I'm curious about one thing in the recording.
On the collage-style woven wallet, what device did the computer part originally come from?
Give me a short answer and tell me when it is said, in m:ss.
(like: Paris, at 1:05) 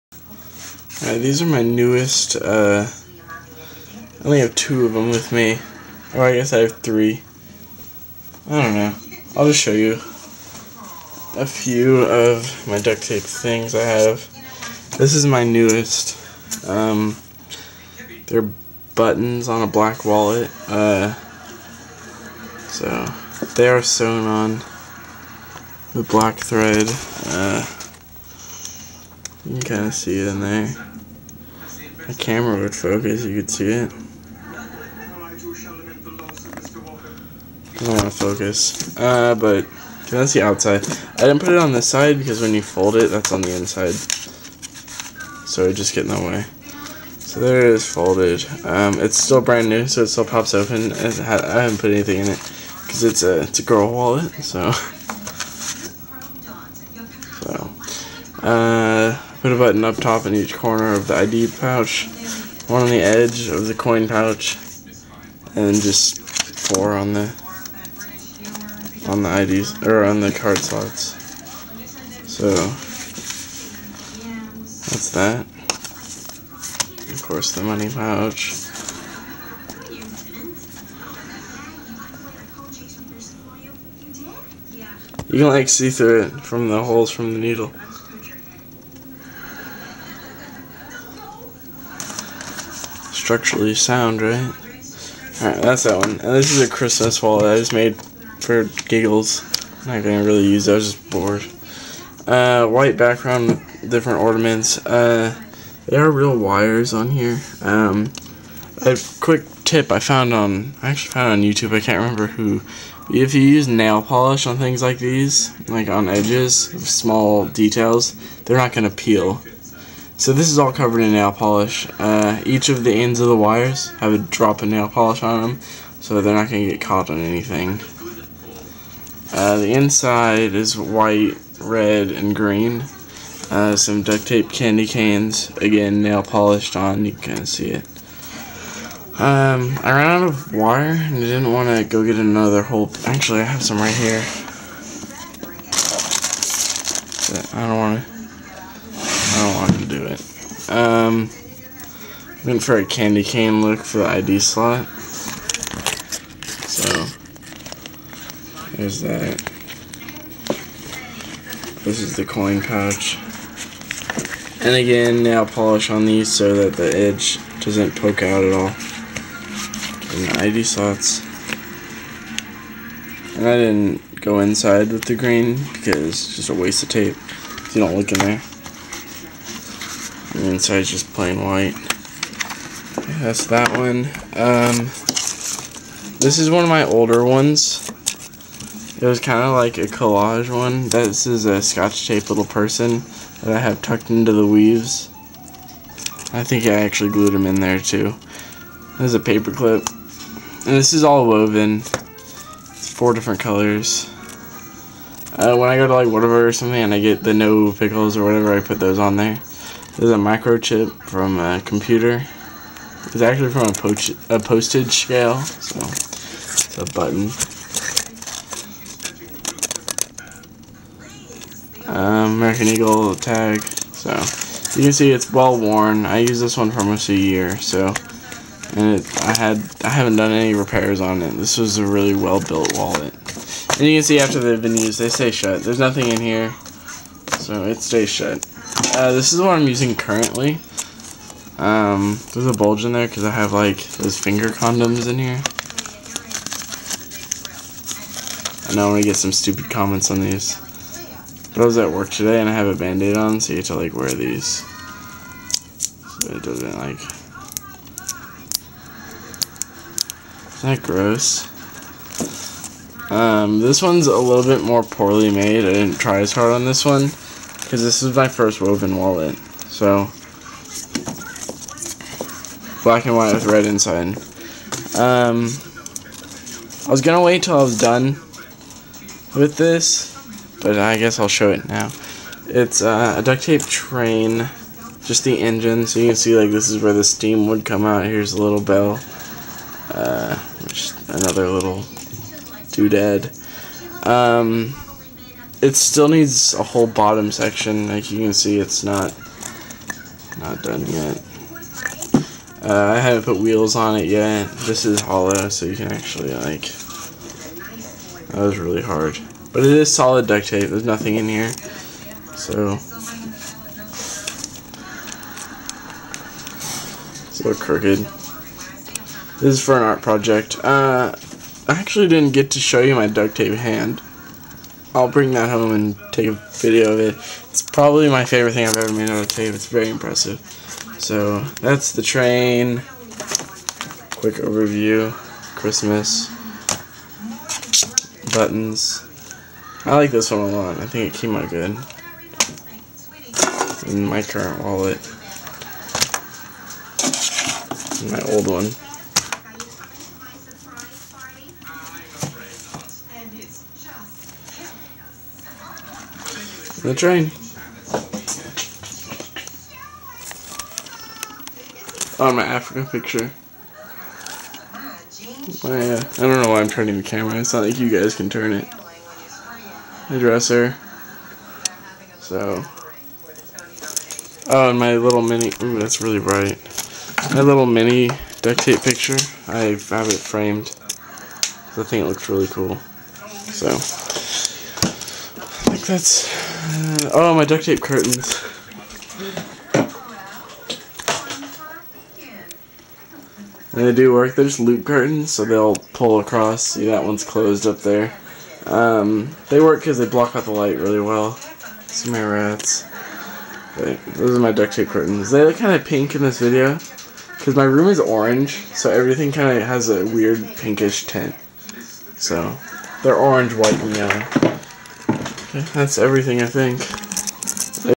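A postage scale, at 3:34.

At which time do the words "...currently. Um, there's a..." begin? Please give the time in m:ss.
3:59.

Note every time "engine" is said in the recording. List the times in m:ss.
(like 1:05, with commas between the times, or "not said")
4:45.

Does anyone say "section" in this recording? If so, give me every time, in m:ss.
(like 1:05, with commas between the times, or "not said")
4:57.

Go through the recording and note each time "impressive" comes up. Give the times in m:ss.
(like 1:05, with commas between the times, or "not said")
5:29.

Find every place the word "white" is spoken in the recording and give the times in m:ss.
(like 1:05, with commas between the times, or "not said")
1:42, 2:10, 3:01, 4:33, 6:53.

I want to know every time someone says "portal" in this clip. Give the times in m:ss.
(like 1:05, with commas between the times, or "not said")
not said.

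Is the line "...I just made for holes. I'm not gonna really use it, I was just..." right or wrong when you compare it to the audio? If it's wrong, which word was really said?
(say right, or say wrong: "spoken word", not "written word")
wrong: "giggles", not "holes".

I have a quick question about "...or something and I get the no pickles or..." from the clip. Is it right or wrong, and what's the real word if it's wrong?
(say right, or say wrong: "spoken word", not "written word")
right.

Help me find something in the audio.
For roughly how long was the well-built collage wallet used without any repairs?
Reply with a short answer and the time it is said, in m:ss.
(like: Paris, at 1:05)
Almost a year, at 3:46.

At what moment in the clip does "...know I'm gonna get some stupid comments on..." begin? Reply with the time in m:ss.
4:08.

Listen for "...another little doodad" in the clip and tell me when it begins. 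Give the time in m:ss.
4:51.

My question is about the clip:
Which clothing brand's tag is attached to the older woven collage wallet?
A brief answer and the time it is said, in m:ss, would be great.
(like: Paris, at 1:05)
American Eagle, at 3:42.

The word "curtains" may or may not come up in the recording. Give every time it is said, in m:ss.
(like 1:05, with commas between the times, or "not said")
6:27, 6:34, 6:44.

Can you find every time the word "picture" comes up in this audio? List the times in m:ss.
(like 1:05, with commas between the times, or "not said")
6:02, 6:18.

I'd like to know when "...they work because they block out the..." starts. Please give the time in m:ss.
6:39.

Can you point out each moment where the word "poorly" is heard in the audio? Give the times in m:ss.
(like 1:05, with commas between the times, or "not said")
4:24.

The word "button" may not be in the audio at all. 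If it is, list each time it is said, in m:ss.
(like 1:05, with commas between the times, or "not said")
0:18, 0:59, 3:36, 5:38.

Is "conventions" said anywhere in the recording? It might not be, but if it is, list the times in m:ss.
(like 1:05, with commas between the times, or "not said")
not said.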